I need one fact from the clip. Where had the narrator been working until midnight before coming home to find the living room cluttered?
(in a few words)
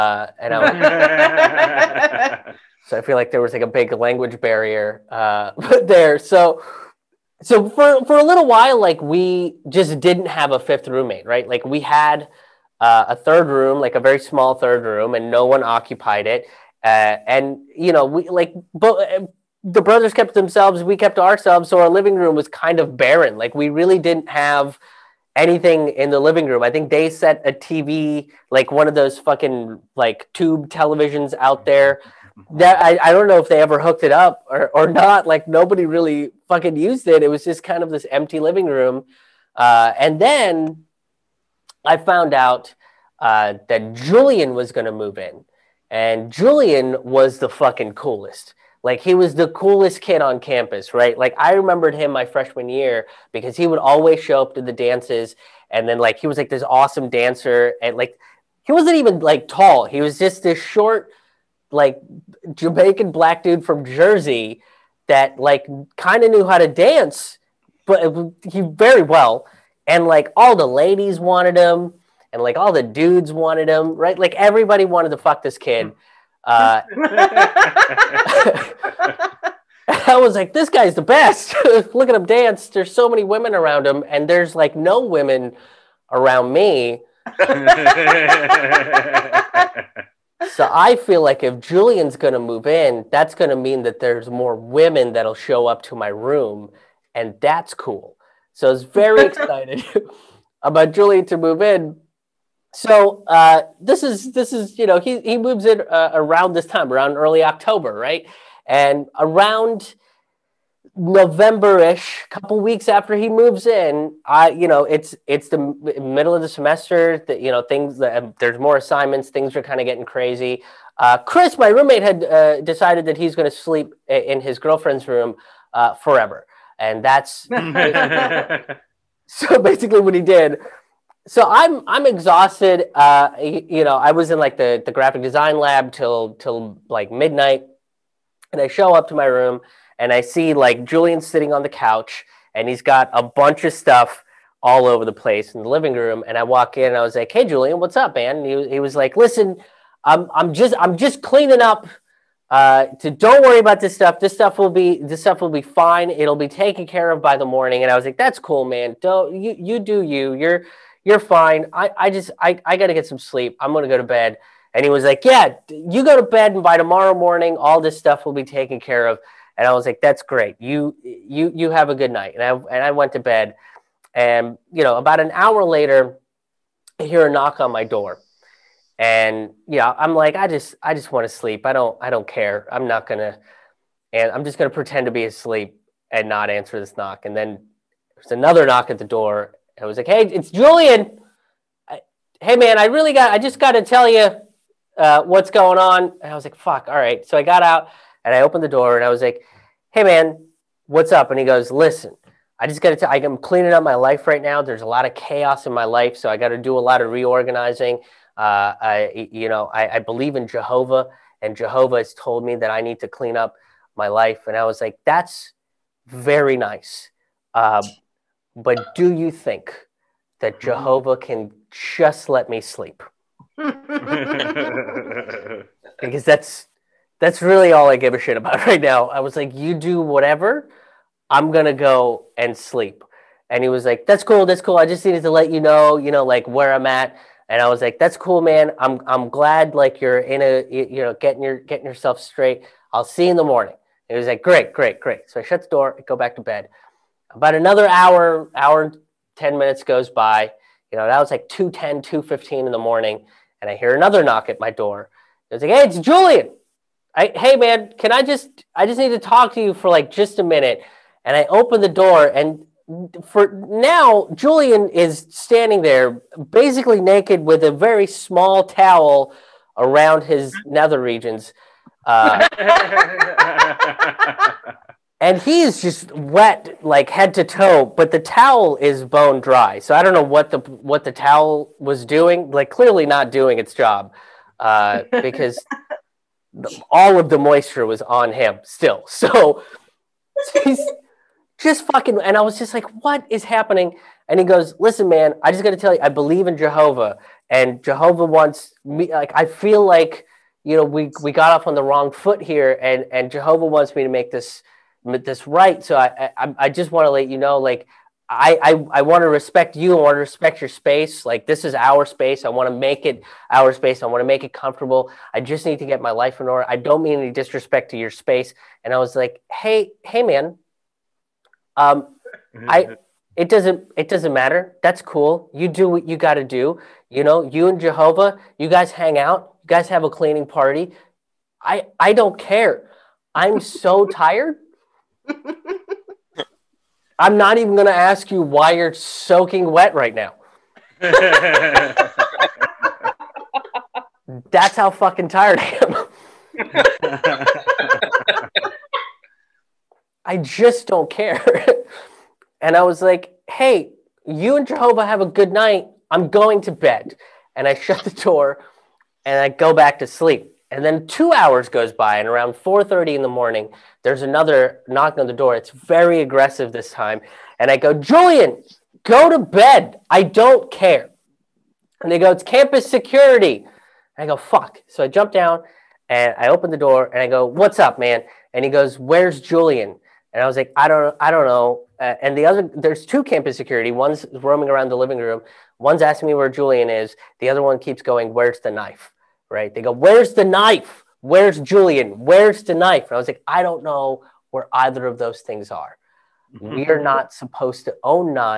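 Graphic design lab.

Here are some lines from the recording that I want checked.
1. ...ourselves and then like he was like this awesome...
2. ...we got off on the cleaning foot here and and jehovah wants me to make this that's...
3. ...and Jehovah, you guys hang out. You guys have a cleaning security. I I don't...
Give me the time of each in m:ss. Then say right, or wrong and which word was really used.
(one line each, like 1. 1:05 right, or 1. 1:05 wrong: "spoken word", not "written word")
1. 0:54 wrong: "dances", not "ourselves"
2. 5:01 wrong: "wrong", not "cleaning"
3. 5:27 wrong: "party", not "security".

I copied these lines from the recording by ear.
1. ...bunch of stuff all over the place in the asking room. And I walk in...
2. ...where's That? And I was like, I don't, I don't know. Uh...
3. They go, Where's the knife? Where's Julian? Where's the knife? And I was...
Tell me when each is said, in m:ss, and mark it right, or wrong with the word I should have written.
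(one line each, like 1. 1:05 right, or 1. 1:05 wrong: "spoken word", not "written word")
1. 2:23 wrong: "living", not "asking"
2. 6:18 wrong: "Julian", not "That"
3. 6:29 right.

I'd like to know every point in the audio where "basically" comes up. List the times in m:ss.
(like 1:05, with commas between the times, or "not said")
2:09, 4:26.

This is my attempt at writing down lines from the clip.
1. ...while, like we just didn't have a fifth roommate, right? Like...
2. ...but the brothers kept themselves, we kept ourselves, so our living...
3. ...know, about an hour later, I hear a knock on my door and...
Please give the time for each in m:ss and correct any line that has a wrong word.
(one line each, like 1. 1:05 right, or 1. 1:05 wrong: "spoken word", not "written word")
1. 0:08 right
2. 0:18 right
3. 2:54 right.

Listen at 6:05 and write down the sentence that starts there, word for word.
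It's very aggressive this time, and I go, Julian, go to bed.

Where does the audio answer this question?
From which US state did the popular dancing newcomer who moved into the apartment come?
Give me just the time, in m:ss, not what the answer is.
1:03.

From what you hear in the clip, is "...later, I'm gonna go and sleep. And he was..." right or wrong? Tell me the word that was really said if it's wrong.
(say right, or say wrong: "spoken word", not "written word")
wrong: "whatever", not "later".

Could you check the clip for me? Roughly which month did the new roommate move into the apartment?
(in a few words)
October.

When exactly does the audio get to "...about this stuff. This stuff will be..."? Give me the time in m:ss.
2:33.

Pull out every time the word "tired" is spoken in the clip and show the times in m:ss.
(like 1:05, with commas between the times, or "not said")
5:34, 5:45.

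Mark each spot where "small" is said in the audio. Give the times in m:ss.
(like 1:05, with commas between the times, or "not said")
0:14, 4:28.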